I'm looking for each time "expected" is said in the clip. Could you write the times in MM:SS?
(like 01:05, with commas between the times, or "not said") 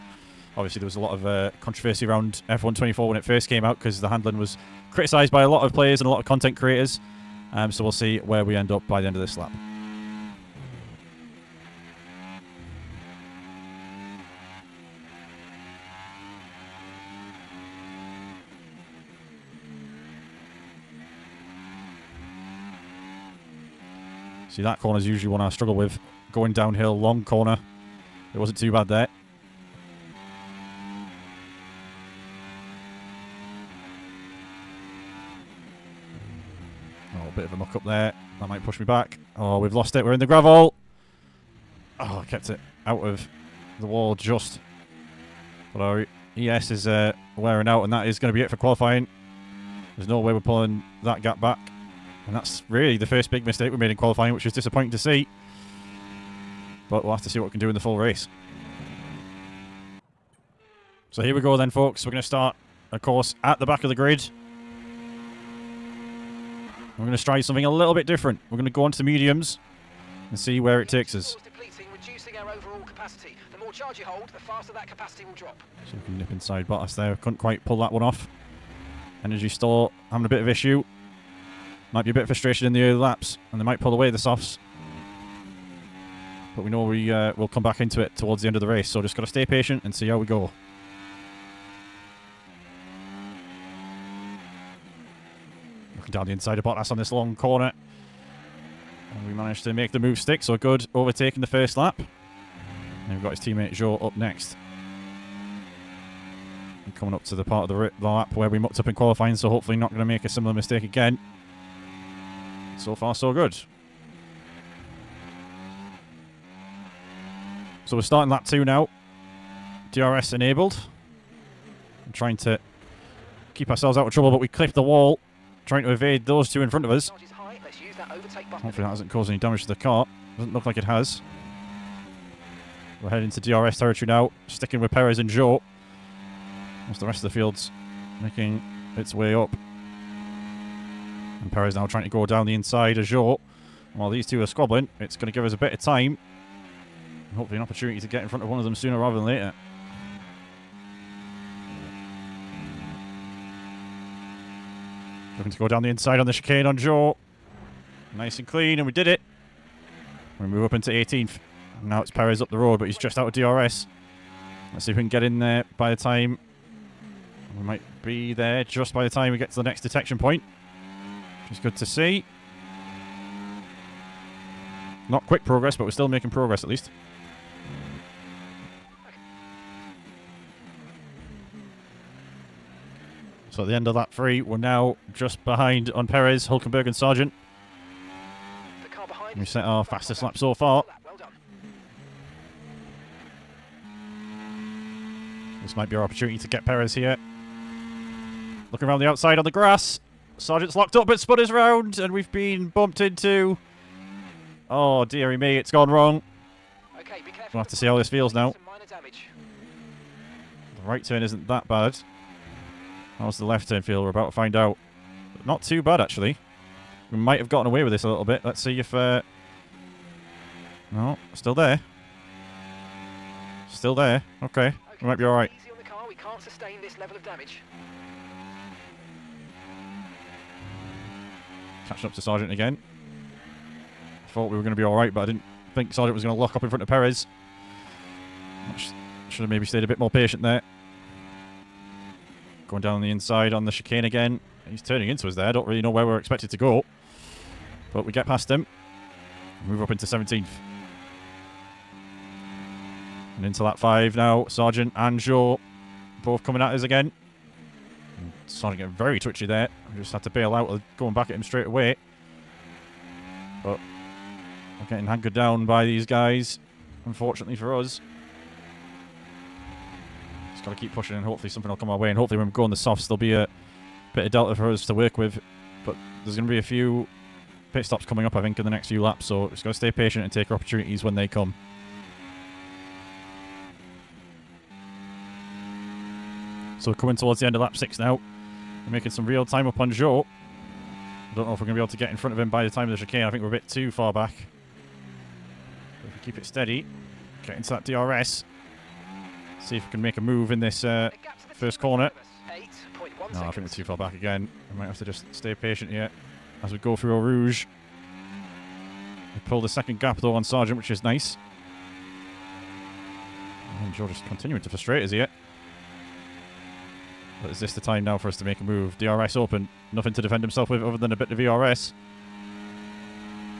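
04:06.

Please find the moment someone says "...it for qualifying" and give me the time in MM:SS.
00:48.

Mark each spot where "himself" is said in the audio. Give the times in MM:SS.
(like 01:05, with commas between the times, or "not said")
05:20.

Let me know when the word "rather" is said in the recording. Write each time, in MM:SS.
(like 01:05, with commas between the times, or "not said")
02:28.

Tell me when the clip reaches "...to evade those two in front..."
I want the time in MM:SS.
02:05.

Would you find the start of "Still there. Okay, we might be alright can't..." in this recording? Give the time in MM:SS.
03:43.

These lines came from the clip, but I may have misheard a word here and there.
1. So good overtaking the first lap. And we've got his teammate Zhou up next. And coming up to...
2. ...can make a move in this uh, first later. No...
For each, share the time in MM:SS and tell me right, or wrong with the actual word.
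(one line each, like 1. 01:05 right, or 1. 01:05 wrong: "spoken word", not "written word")
1. 01:40 right
2. 04:59 wrong: "corner", not "later".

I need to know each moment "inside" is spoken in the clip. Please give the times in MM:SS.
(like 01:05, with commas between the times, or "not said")
01:16, 01:36, 02:22, 02:35, 04:03.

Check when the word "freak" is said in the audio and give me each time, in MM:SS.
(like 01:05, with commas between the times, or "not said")
not said.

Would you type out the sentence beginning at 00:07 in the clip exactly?
Um, so we'll see where we end up by the end of this lap.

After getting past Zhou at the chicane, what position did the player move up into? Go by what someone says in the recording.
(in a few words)
18th.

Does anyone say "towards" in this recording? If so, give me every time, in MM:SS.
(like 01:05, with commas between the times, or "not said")
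01:28, 04:47.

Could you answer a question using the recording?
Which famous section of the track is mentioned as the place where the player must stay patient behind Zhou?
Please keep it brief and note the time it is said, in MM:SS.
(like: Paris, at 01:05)
Eau Rouge, at 05:07.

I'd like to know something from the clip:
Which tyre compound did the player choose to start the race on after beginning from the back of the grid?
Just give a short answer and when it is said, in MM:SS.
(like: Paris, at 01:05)
Mediums, at 01:09.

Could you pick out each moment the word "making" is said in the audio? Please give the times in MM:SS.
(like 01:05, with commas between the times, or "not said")
02:18, 02:56, 04:48.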